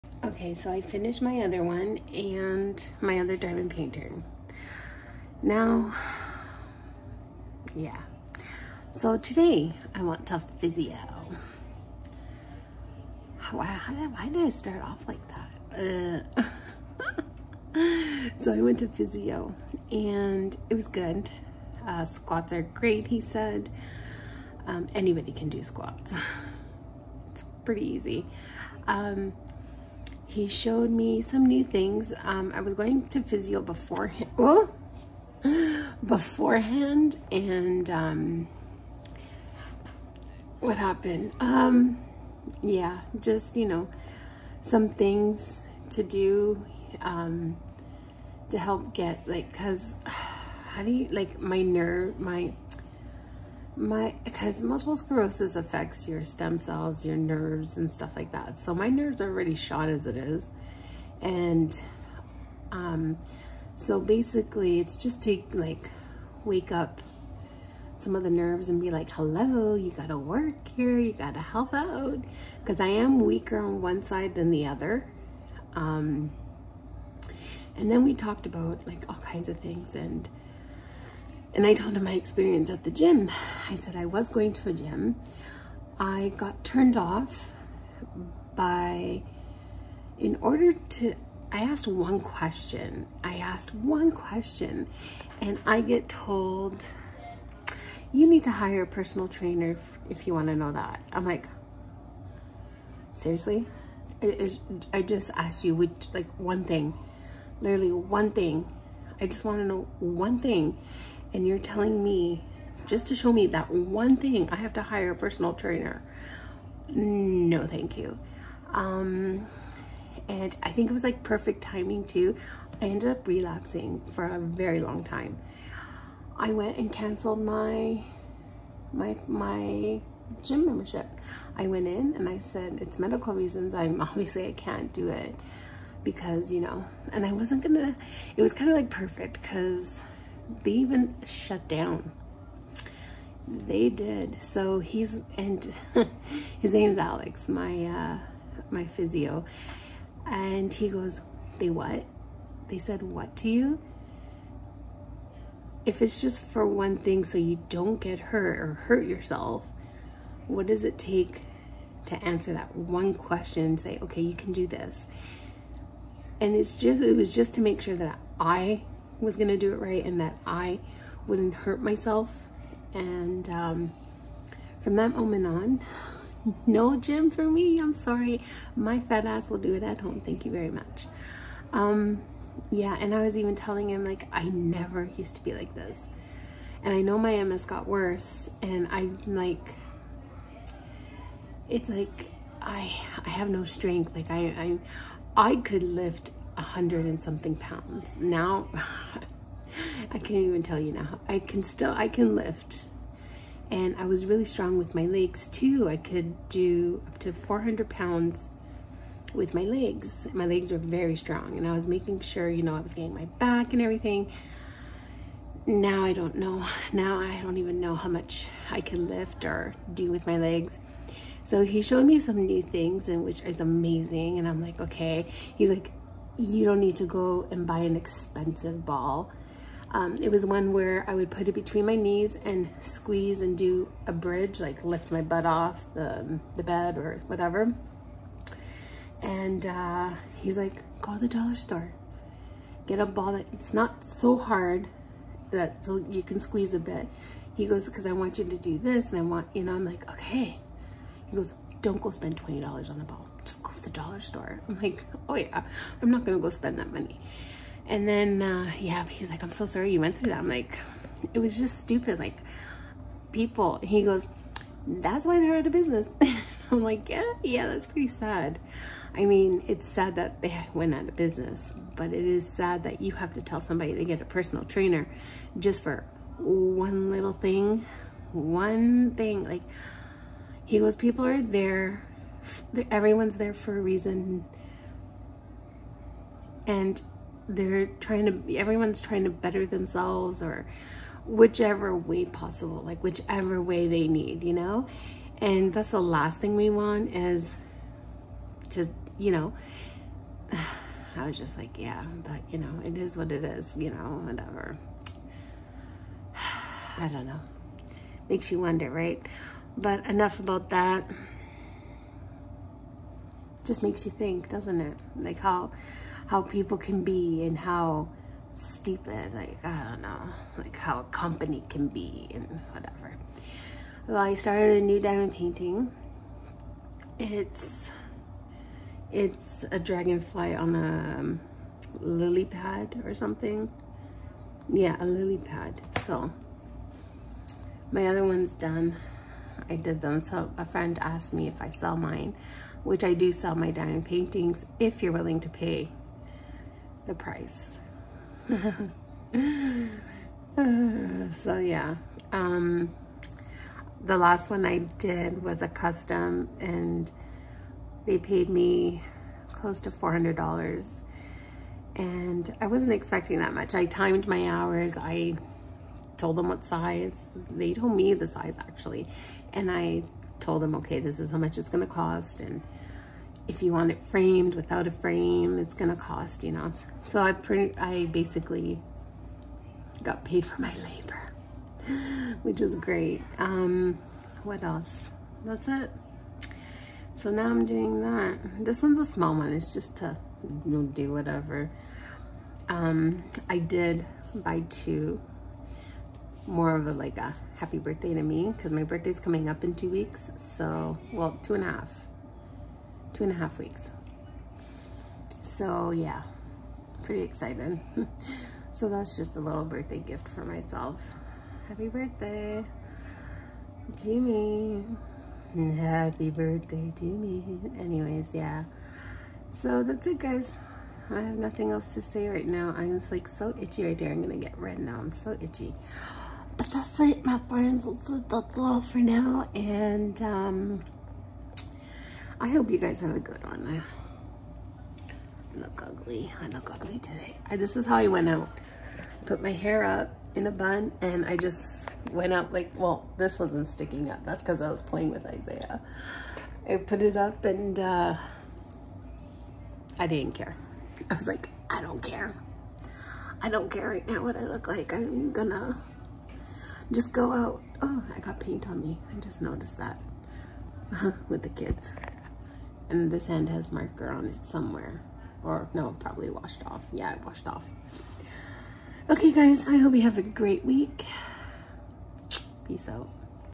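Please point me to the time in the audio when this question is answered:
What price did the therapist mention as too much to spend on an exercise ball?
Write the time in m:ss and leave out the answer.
4:12.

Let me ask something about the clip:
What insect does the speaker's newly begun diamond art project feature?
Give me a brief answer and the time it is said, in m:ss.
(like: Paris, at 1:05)
dragonfly, at 5:29.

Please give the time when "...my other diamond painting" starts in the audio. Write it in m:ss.
0:03.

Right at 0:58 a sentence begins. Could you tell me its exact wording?
So my nerves are already shot as it is.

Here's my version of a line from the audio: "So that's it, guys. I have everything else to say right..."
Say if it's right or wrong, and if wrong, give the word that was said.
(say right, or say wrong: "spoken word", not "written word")
wrong: "nothing", not "everything".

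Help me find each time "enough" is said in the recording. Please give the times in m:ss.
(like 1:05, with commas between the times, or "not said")
5:10.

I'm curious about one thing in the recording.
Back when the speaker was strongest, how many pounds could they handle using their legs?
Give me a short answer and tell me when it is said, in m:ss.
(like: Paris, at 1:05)
400 pounds, at 3:27.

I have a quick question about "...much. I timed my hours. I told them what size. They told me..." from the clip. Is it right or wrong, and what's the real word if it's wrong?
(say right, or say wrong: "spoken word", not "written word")
right.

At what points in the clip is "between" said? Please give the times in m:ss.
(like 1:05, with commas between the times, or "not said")
3:51.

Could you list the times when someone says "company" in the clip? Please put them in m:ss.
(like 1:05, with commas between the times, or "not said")
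5:21.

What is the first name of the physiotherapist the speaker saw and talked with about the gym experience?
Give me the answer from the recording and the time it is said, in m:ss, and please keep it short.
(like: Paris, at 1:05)
Alex, at 2:26.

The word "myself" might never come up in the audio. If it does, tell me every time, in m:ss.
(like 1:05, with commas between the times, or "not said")
2:51, 6:50.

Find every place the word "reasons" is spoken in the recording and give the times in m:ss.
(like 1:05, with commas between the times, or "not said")
2:13, 4:43.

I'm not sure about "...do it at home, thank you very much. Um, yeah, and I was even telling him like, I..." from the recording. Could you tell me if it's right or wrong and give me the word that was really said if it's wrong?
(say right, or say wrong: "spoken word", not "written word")
right.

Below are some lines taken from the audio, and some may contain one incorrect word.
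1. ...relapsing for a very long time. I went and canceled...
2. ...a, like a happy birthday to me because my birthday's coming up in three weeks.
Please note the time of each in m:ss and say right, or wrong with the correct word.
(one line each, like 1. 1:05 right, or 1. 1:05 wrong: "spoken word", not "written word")
1. 2:03 right
2. 6:36 wrong: "two", not "three".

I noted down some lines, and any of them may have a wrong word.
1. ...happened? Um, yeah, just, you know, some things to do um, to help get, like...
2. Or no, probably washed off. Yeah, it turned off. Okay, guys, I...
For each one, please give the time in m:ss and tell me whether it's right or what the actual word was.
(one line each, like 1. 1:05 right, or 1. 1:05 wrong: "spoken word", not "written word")
1. 0:40 right
2. 7:45 wrong: "washed", not "turned".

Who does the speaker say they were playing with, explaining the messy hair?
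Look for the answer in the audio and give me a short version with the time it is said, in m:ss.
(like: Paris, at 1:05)
Isaiah, at 7:25.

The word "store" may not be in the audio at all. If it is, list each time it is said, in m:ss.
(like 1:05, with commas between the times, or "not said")
4:01, 4:14.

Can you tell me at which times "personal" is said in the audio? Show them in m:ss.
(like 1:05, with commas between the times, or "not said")
1:38, 1:55, 4:34.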